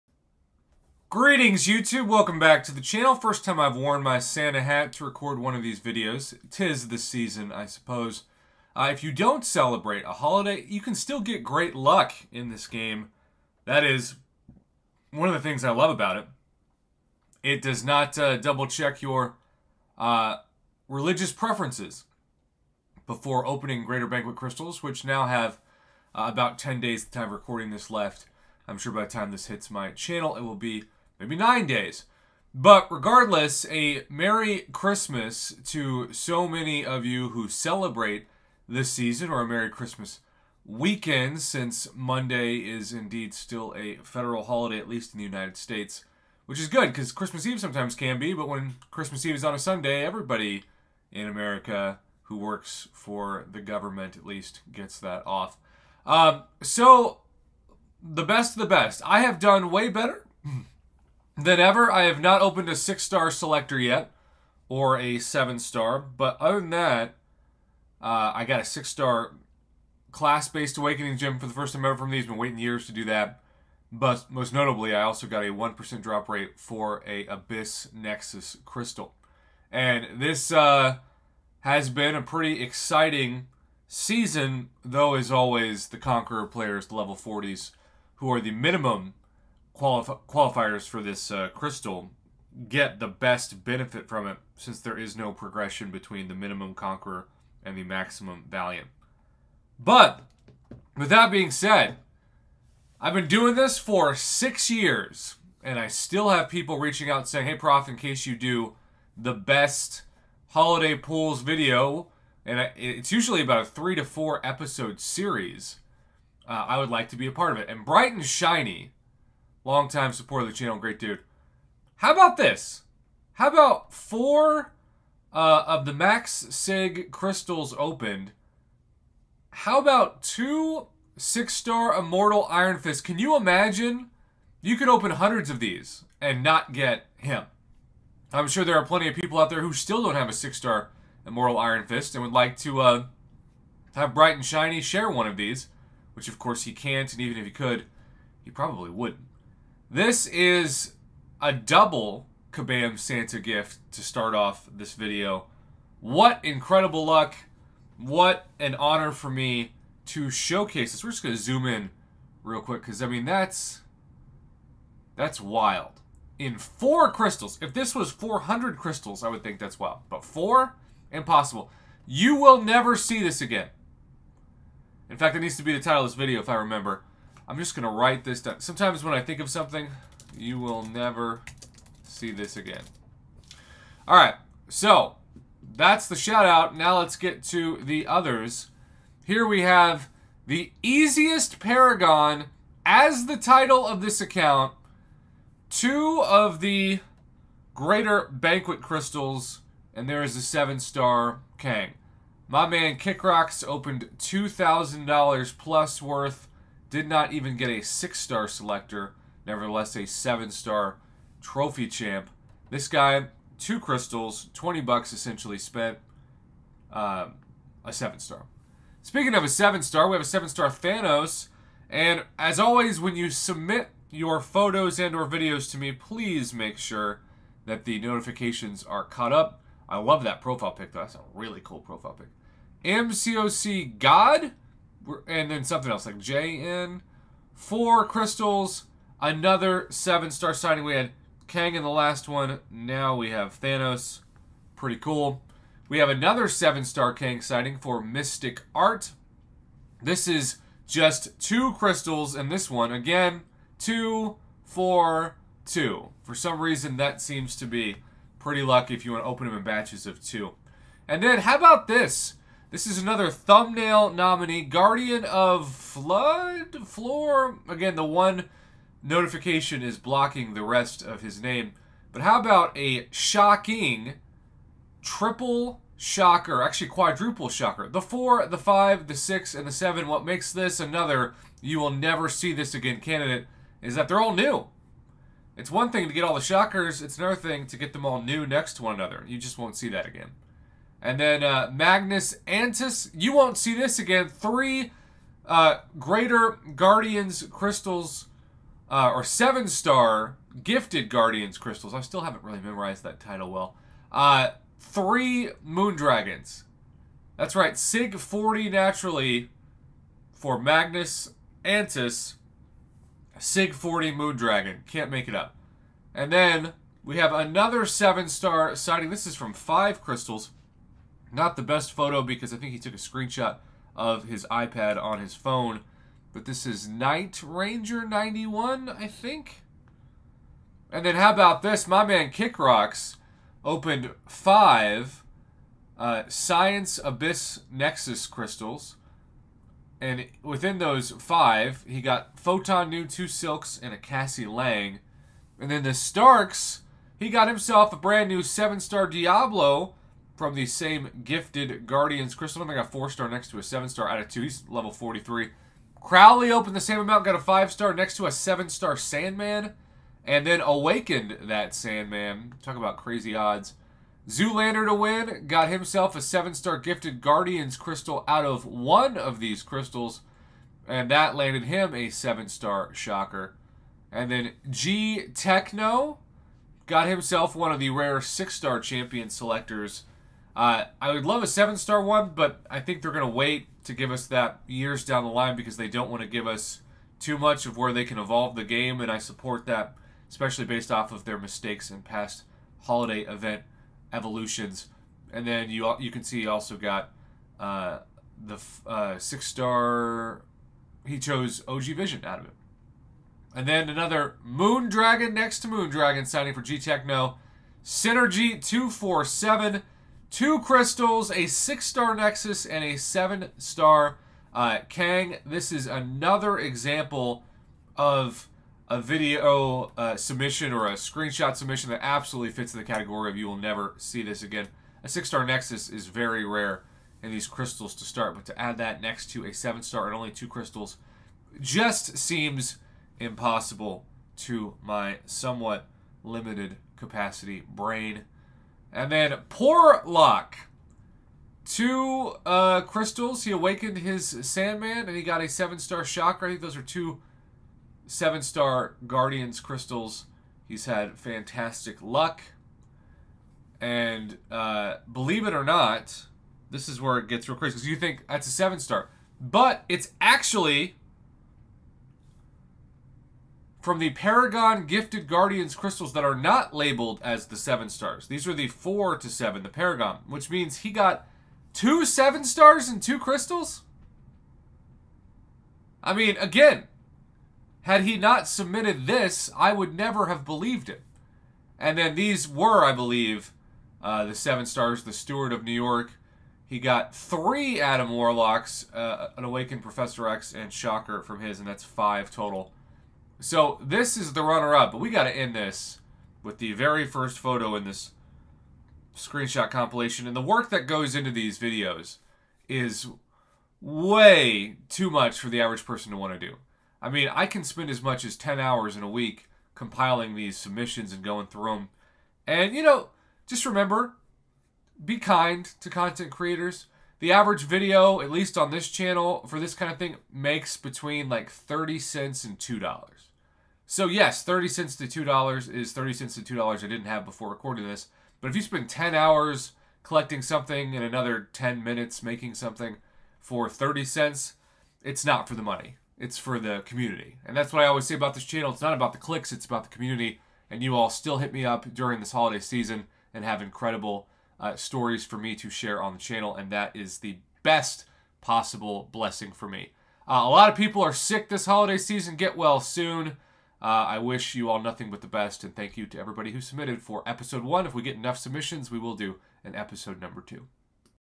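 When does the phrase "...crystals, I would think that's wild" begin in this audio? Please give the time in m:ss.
2:48.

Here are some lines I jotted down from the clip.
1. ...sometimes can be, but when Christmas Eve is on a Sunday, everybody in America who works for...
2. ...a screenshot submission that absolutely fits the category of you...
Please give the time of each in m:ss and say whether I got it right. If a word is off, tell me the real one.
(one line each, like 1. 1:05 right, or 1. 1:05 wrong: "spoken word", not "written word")
1. 0:47 right
2. 7:00 right.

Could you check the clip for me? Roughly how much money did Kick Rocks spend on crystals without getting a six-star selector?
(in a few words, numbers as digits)
$2,000.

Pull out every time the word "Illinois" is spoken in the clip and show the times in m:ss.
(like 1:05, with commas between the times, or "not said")
not said.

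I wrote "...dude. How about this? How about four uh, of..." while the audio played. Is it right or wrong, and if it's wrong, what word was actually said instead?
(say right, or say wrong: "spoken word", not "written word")
right.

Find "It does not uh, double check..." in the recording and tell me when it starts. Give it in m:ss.
0:17.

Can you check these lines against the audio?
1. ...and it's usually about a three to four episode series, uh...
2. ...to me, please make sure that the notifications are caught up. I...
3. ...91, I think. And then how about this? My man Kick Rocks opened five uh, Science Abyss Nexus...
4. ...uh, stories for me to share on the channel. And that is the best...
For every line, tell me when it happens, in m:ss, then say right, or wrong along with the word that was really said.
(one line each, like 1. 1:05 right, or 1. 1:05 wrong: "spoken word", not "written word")
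1. 1:52 right
2. 3:45 right
3. 5:28 right
4. 9:04 right.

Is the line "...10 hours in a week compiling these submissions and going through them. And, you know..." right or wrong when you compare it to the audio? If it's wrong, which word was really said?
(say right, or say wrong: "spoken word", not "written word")
right.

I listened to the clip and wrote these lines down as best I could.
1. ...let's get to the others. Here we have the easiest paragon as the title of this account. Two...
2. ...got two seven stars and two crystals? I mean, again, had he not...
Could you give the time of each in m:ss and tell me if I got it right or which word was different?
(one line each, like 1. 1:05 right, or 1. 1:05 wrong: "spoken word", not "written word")
1. 3:06 right
2. 7:50 right.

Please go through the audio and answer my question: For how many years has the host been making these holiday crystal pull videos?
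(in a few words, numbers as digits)
6.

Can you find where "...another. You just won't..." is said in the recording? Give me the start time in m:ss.
4:48.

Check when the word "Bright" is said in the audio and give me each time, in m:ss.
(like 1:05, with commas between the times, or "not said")
1:57, 2:24.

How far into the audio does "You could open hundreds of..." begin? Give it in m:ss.
2:14.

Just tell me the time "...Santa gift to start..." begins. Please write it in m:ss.
2:32.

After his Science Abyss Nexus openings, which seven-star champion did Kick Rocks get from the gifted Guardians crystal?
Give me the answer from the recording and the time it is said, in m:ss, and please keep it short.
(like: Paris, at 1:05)
Diablo, at 5:49.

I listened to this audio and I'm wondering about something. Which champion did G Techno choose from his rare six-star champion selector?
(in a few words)
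OG Vision.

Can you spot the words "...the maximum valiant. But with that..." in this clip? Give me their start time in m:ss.
1:37.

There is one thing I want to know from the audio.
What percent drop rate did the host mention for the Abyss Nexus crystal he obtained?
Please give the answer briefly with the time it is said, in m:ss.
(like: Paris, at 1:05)
1%, at 1:15.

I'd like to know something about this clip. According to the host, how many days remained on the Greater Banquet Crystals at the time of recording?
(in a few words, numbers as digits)
10.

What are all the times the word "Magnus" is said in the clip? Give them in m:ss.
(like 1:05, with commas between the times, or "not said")
4:51, 5:10.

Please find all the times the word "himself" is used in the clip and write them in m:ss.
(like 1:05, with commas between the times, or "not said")
5:47, 6:05, 6:17.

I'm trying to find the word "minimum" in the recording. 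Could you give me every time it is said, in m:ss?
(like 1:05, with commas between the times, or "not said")
1:28, 1:36.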